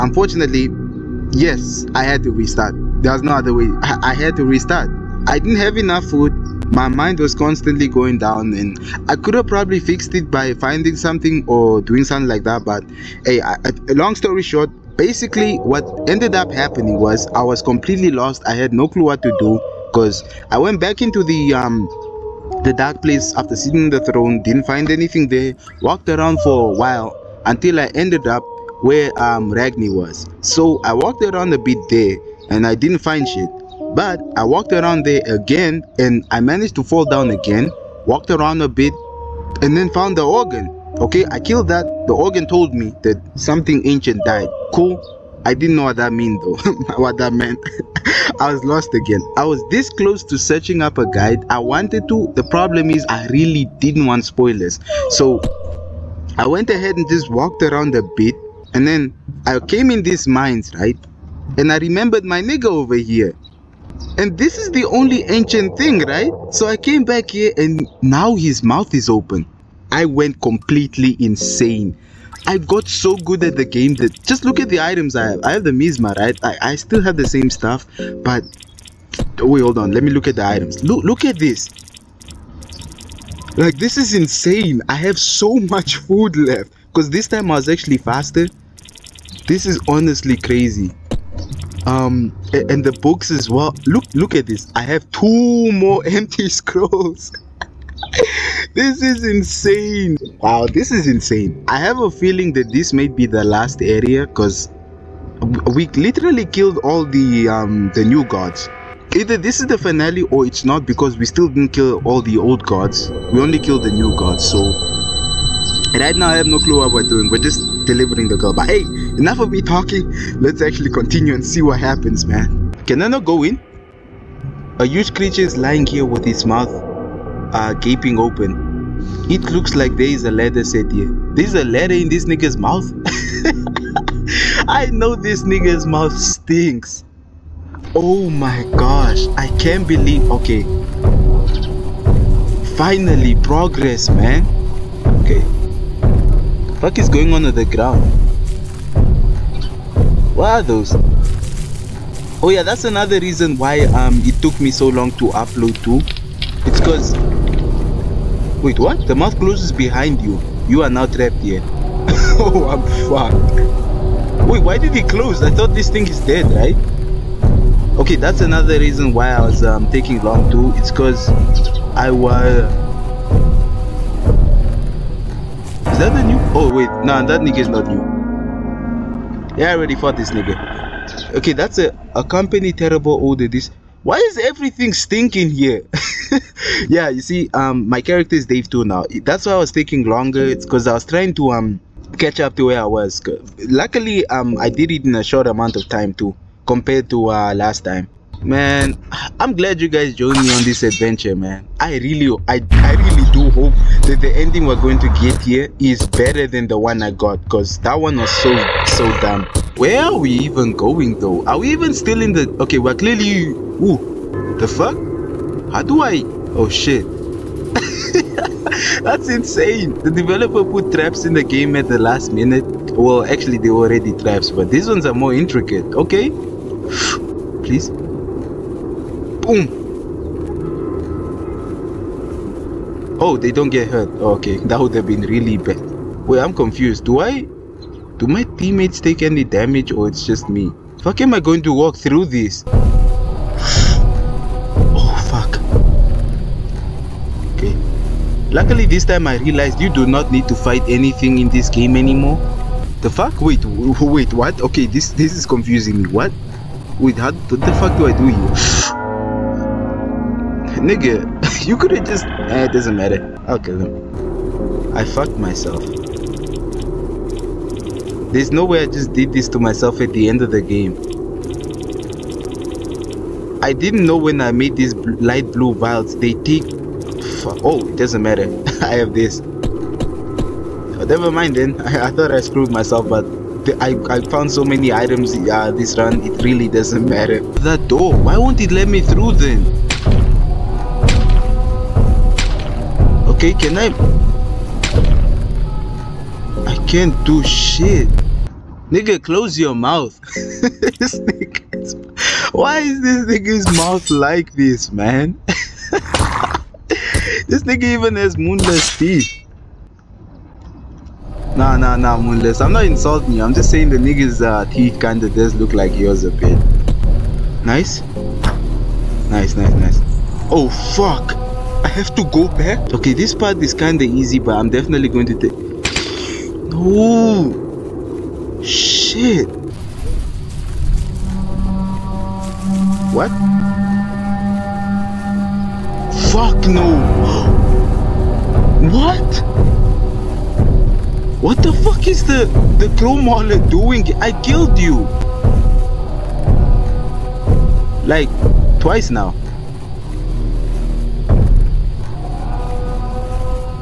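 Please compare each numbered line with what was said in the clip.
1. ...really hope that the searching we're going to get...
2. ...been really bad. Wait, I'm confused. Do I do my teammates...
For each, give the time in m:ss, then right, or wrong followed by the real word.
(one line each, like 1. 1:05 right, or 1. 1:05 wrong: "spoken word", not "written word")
1. 3:22 wrong: "ending", not "searching"
2. 3:55 right.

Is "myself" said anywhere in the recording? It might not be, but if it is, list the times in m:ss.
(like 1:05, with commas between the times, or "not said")
4:25, 4:29, 4:42.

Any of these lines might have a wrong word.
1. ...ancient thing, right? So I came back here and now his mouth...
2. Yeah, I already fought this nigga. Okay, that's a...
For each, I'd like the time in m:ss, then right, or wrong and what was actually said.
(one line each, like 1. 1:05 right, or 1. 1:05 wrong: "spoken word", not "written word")
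1. 1:05 right
2. 2:59 right.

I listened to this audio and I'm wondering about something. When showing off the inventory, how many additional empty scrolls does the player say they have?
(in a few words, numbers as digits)
2.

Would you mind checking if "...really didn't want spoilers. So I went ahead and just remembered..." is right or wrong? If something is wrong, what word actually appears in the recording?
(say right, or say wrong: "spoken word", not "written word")
wrong: "walked", not "remembered".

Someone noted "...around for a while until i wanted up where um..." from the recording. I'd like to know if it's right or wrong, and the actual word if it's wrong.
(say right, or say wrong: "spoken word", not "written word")
wrong: "ended", not "wanted".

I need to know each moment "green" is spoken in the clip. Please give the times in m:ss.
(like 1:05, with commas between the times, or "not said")
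not said.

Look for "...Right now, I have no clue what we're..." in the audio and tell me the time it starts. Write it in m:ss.
1:55.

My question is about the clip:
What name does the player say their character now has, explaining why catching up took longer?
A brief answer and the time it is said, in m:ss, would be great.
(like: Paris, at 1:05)
Dave 2, at 3:08.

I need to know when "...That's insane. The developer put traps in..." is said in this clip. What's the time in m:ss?
3:39.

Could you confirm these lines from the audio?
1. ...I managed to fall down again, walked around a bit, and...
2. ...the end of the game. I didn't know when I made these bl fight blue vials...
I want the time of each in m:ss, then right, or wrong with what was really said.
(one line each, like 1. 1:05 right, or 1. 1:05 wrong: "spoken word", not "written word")
1. 0:36 right
2. 4:30 wrong: "light", not "fight".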